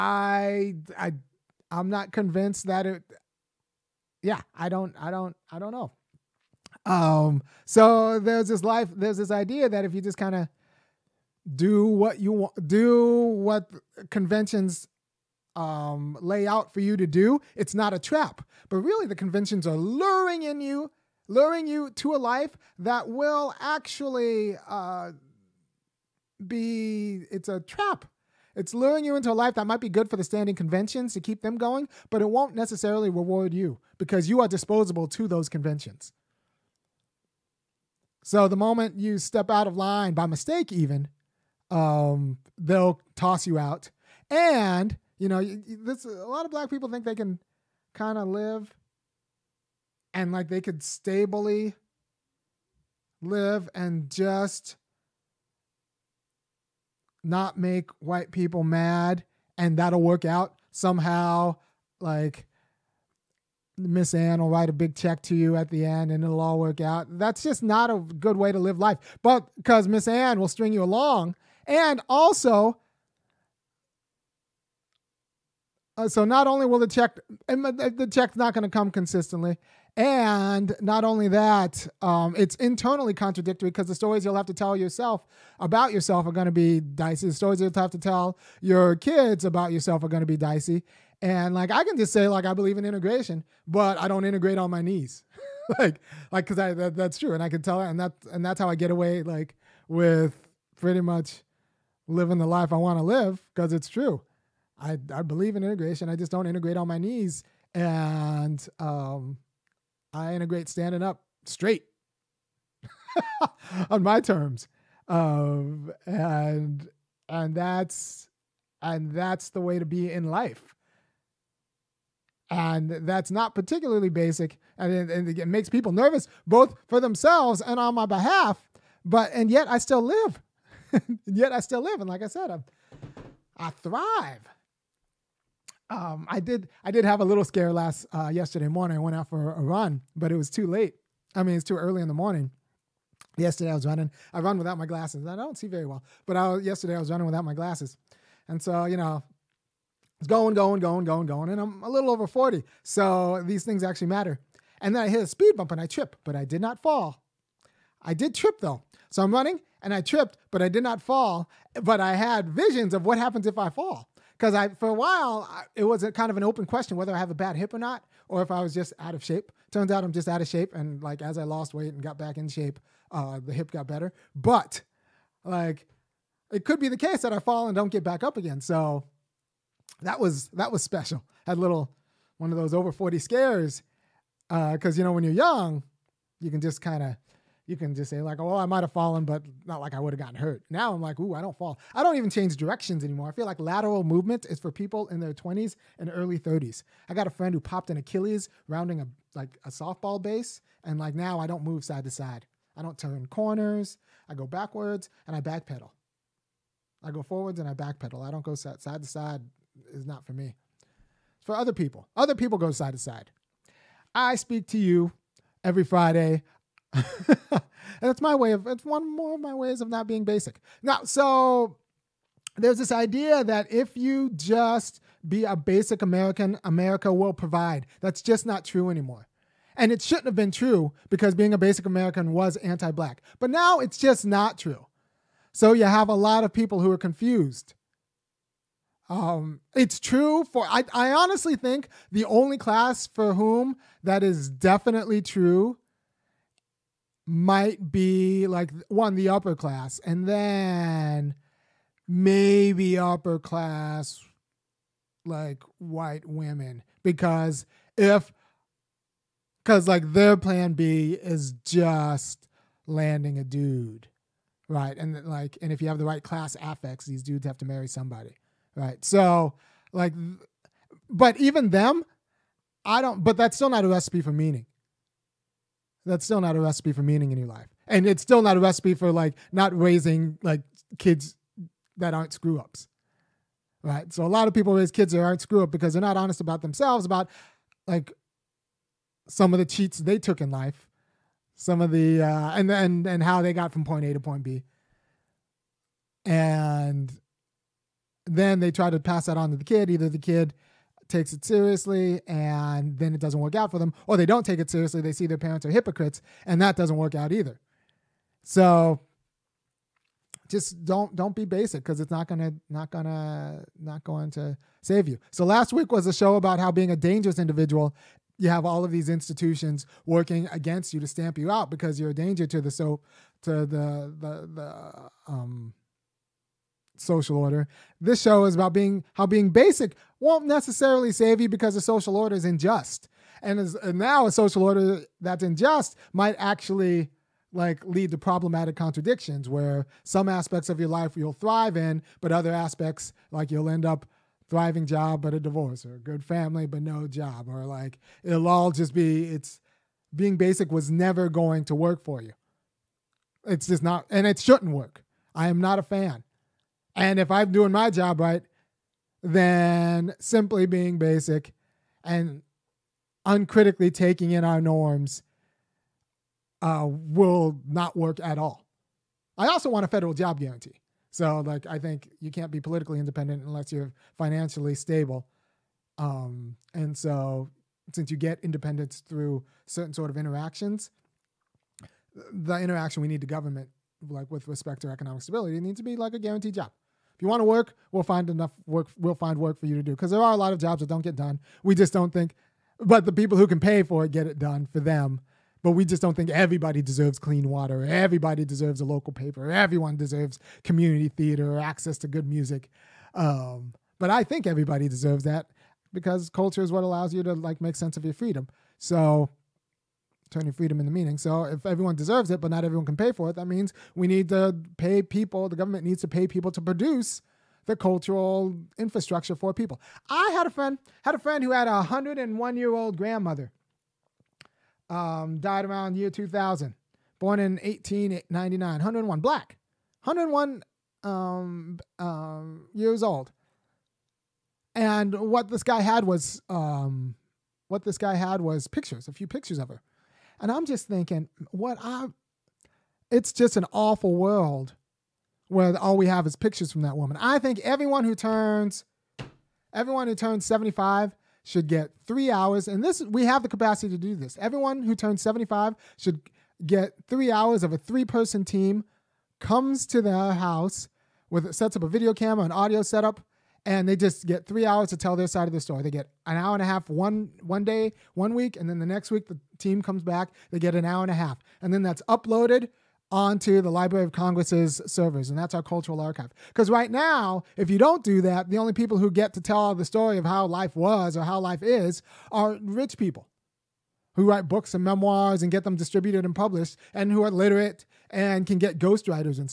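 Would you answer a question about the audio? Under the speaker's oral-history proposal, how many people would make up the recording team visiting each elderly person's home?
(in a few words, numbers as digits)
3.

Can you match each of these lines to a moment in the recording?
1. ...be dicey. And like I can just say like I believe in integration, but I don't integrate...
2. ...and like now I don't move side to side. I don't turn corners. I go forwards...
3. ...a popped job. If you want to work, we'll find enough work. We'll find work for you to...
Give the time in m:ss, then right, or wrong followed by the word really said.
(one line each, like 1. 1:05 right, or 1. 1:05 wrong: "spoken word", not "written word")
1. 1:30 right
2. 3:20 wrong: "backwards", not "forwards"
3. 6:26 wrong: "guaranteed", not "popped".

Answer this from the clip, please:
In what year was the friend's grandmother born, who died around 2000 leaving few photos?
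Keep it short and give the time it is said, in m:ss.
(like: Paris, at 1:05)
1899, at 7:07.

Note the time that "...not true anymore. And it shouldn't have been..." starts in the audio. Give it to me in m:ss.
3:48.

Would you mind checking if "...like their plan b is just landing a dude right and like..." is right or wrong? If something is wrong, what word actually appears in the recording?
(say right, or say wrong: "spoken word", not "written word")
right.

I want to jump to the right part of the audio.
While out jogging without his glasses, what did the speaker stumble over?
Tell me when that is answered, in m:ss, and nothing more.
2:35.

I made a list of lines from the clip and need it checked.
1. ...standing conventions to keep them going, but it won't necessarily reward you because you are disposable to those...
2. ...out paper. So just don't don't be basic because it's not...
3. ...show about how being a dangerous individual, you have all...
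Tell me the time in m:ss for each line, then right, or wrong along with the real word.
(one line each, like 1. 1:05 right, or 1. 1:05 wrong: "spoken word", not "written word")
1. 0:30 right
2. 5:07 wrong: "either", not "paper"
3. 5:16 right.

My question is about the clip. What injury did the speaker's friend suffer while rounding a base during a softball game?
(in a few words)
popped an Achilles.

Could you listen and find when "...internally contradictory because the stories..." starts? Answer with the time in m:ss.
1:22.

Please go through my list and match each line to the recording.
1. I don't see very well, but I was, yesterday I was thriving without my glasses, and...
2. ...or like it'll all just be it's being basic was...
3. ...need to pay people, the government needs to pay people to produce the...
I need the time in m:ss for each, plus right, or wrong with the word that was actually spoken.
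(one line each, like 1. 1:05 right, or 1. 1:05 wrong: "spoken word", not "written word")
1. 2:25 wrong: "running", not "thriving"
2. 5:47 right
3. 6:54 right.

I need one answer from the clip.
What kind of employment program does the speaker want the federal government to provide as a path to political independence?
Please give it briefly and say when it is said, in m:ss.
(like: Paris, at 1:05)
federal job guarantee, at 6:09.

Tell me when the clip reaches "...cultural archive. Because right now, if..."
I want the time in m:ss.
7:55.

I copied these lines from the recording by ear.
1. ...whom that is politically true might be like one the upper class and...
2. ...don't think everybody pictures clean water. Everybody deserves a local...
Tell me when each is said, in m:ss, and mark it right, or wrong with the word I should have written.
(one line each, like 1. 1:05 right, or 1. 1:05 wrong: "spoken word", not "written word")
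1. 4:03 wrong: "definitely", not "politically"
2. 6:36 wrong: "deserves", not "pictures".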